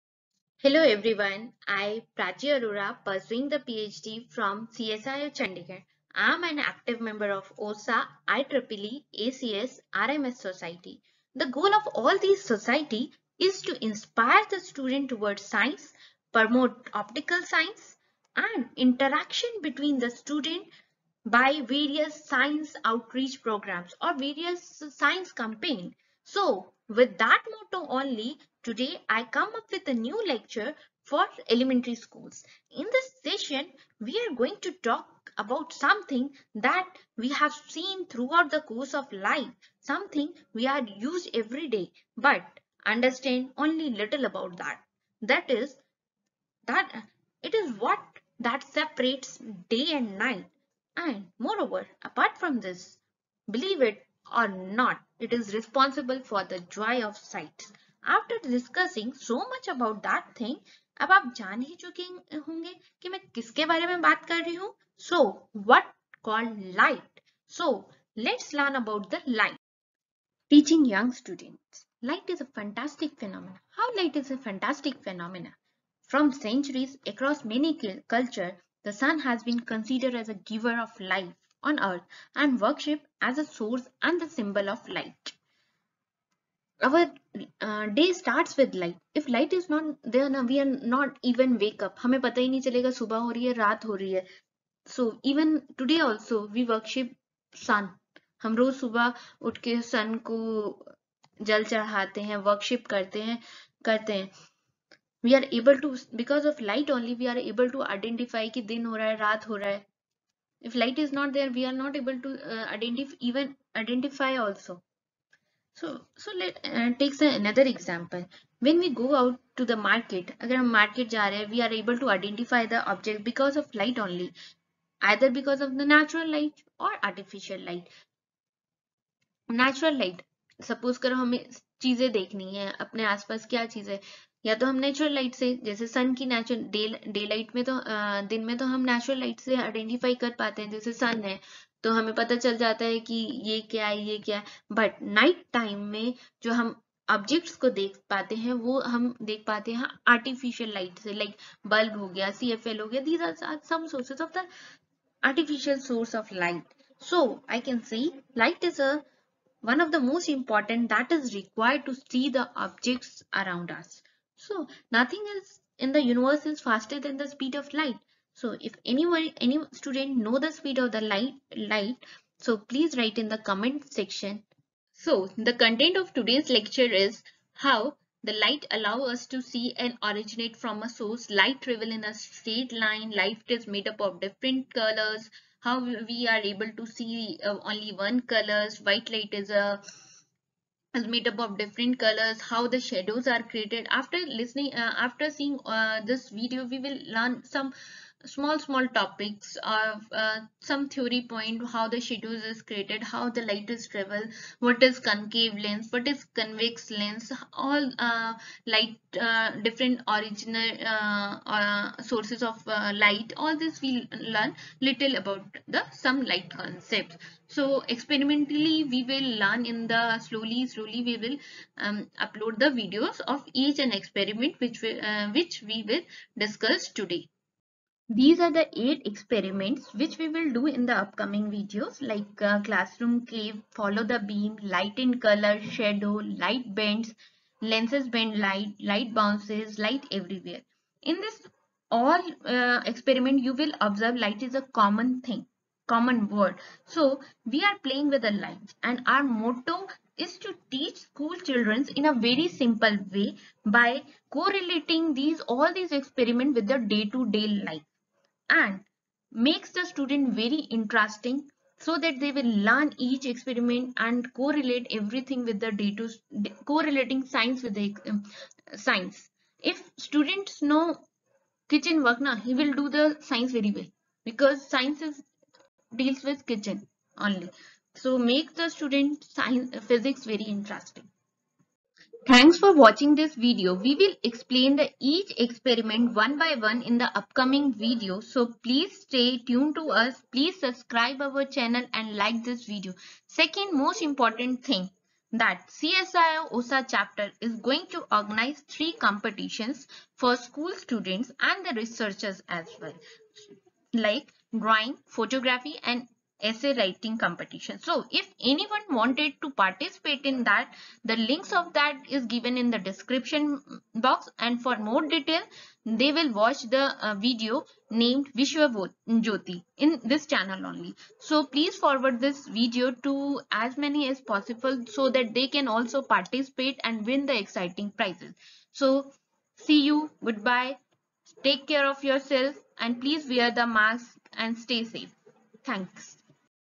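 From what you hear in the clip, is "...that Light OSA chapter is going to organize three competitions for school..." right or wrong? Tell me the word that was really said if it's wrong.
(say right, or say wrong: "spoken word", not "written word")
wrong: "CSIO", not "Light".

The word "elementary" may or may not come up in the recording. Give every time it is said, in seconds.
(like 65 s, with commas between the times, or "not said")
31 s.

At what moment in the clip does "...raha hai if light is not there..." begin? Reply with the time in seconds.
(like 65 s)
109 s.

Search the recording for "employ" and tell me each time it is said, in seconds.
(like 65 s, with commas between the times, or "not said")
not said.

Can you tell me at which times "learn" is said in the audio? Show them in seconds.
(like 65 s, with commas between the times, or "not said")
68 s, 197 s, 214 s, 219 s, 262 s.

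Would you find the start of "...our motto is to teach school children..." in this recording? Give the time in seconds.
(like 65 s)
249 s.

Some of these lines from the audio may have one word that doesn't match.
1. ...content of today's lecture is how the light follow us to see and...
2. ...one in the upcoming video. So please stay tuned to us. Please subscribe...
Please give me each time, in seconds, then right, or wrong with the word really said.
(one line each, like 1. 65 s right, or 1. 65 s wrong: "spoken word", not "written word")
1. 175 s wrong: "allow", not "follow"
2. 286 s right.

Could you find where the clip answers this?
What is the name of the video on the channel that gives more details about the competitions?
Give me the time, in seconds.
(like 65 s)
318 s.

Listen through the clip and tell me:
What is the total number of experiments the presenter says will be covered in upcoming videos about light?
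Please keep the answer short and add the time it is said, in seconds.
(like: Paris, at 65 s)
8, at 228 s.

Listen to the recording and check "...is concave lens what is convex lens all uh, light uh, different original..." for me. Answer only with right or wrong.
right.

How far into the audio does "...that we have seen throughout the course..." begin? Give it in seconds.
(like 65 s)
36 s.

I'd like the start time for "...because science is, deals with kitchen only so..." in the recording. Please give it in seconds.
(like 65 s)
274 s.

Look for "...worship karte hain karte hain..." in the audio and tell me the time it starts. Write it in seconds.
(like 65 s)
102 s.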